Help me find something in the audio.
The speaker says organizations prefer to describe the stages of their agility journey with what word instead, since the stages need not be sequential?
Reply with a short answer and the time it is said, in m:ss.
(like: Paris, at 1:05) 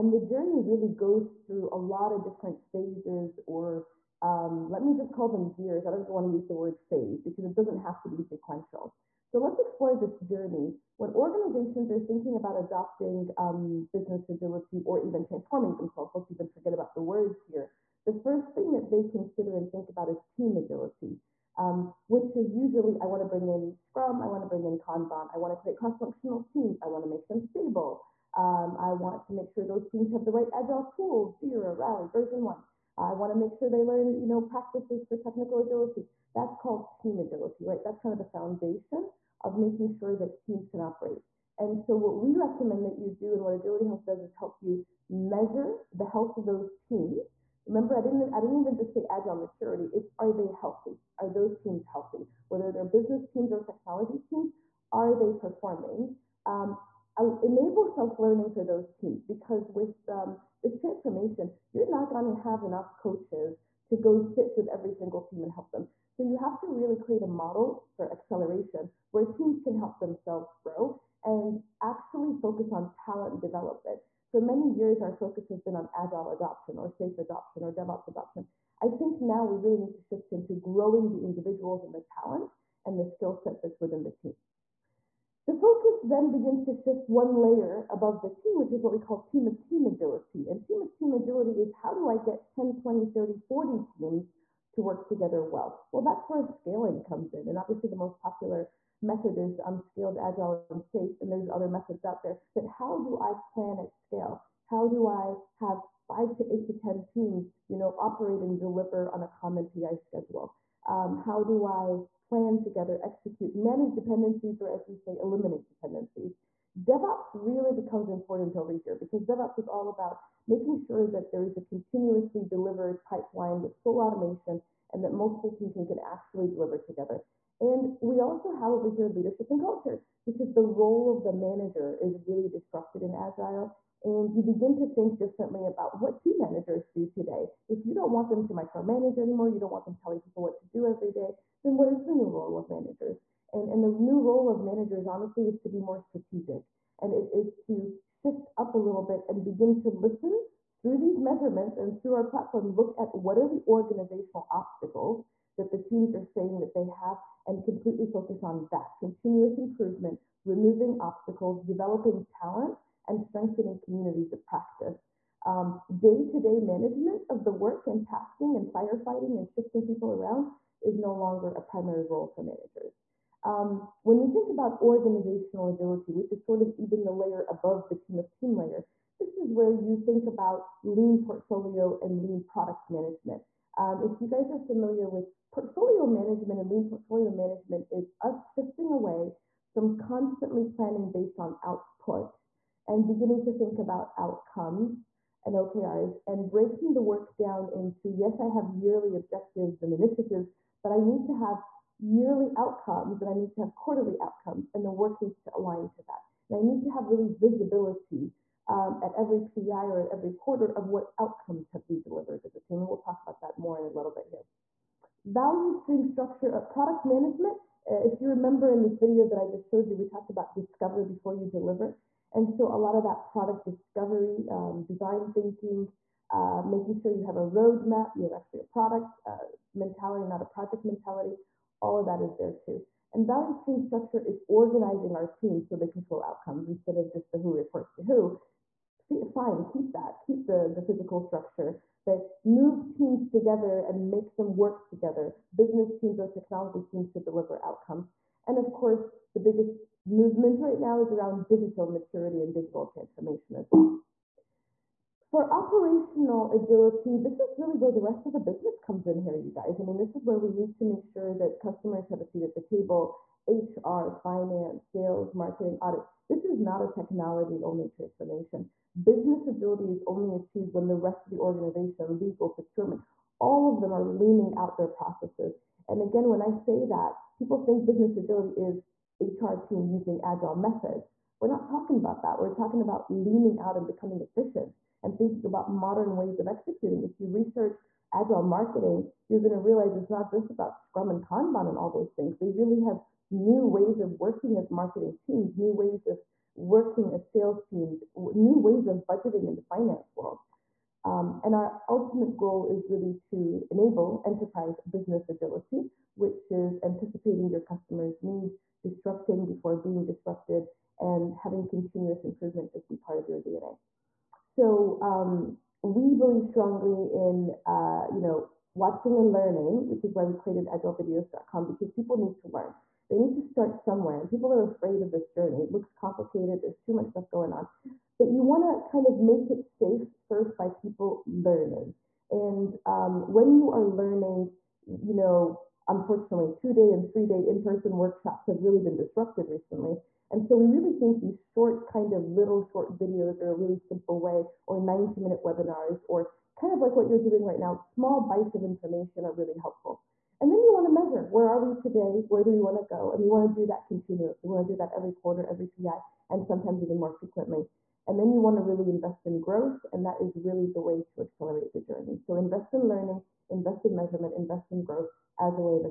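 gears, at 0:05.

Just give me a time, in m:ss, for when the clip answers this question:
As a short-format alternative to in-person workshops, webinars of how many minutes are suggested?
5:44.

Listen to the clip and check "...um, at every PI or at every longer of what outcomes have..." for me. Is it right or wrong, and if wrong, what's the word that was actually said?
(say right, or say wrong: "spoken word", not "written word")
wrong: "quarter", not "longer".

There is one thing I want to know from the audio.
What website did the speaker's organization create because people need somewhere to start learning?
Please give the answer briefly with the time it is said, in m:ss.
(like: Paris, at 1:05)
agilevideos.com, at 5:20.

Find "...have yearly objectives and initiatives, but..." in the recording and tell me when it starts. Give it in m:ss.
3:18.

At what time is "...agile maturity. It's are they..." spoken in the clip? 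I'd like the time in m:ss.
0:49.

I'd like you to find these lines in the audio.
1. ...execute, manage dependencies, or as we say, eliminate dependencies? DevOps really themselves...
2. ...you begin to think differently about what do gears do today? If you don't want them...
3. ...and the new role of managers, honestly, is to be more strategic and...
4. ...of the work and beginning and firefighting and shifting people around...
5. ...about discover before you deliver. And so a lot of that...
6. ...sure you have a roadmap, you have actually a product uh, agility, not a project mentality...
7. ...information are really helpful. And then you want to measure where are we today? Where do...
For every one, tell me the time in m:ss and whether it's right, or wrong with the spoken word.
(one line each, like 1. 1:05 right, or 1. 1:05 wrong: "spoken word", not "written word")
1. 1:53 wrong: "becomes", not "themselves"
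2. 2:14 wrong: "managers", not "gears"
3. 2:23 right
4. 2:47 wrong: "tasking", not "beginning"
5. 3:40 right
6. 3:46 wrong: "mentality", not "agility"
7. 5:48 right.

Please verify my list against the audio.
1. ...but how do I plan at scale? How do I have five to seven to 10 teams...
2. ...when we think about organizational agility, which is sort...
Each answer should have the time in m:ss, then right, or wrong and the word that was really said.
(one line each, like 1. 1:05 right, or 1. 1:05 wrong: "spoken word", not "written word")
1. 1:42 wrong: "eight", not "seven"
2. 2:54 right.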